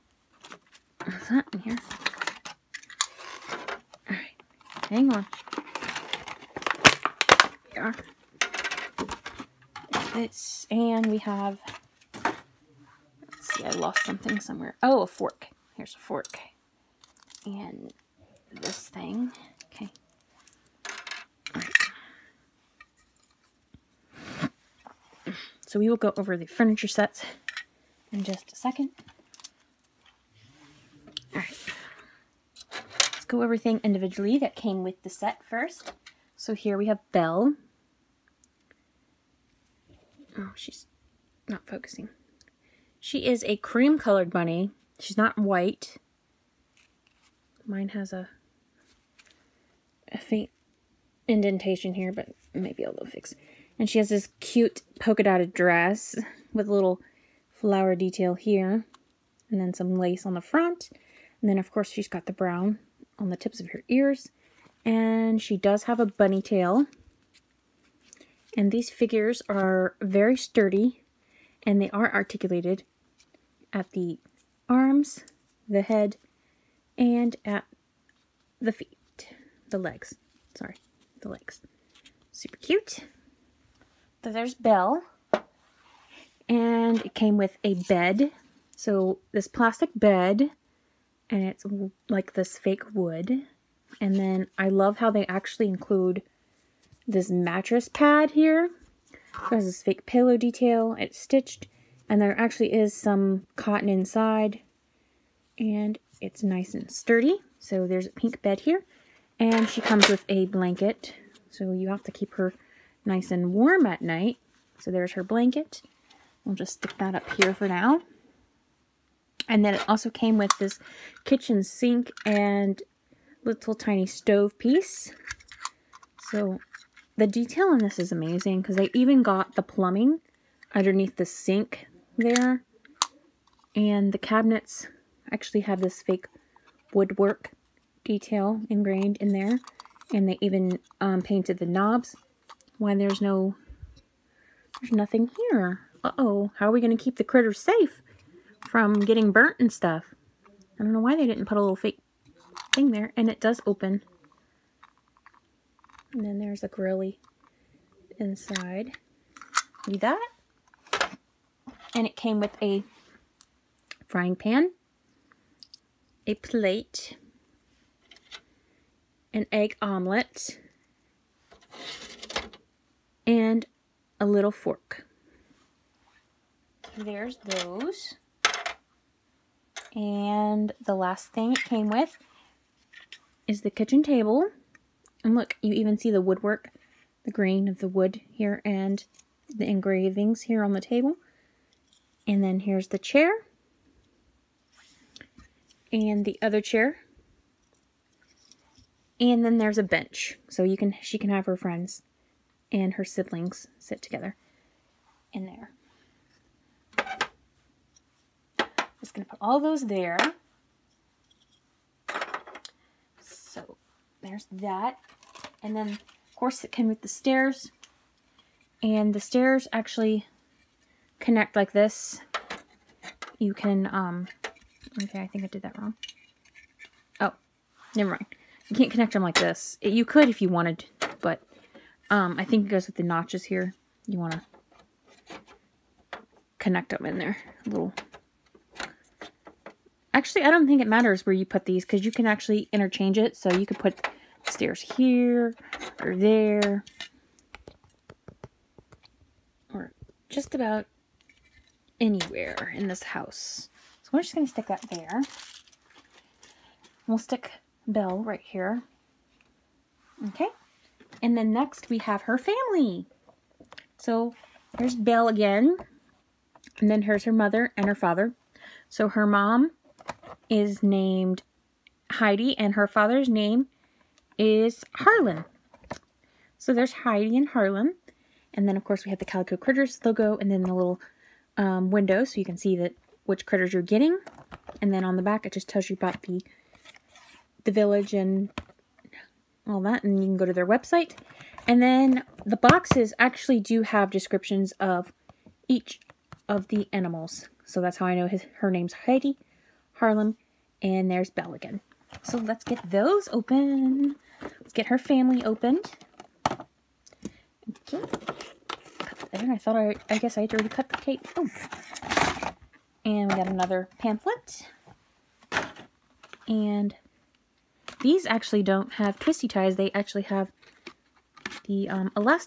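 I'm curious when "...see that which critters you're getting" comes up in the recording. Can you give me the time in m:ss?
4:42.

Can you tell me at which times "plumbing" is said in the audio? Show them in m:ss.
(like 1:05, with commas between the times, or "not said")
2:09.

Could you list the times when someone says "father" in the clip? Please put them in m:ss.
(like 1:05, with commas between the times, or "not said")
4:27, 4:32.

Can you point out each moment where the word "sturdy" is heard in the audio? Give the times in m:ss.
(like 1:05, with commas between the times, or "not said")
1:10, 1:46.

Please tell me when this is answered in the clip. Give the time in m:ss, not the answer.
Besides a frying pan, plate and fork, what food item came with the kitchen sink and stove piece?
2:49.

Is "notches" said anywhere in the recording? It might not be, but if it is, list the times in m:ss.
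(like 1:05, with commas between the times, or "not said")
3:53.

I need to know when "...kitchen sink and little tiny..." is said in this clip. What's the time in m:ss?
2:01.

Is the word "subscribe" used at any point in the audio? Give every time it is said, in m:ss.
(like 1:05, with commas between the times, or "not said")
not said.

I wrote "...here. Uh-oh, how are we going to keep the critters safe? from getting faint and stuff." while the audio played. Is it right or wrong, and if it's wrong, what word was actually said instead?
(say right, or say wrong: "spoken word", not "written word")
wrong: "burnt", not "faint".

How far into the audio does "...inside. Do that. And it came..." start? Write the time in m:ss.
2:38.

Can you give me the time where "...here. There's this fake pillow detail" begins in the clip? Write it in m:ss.
1:38.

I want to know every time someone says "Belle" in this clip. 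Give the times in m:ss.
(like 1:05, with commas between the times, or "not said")
0:37, 1:24, 4:17, 4:24, 5:01.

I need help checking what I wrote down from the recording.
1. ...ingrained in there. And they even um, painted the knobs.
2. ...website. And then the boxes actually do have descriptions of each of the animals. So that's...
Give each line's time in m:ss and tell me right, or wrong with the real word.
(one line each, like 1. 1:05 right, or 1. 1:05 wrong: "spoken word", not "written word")
1. 2:18 right
2. 4:50 right.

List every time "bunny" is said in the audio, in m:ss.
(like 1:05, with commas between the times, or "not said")
0:44, 1:06.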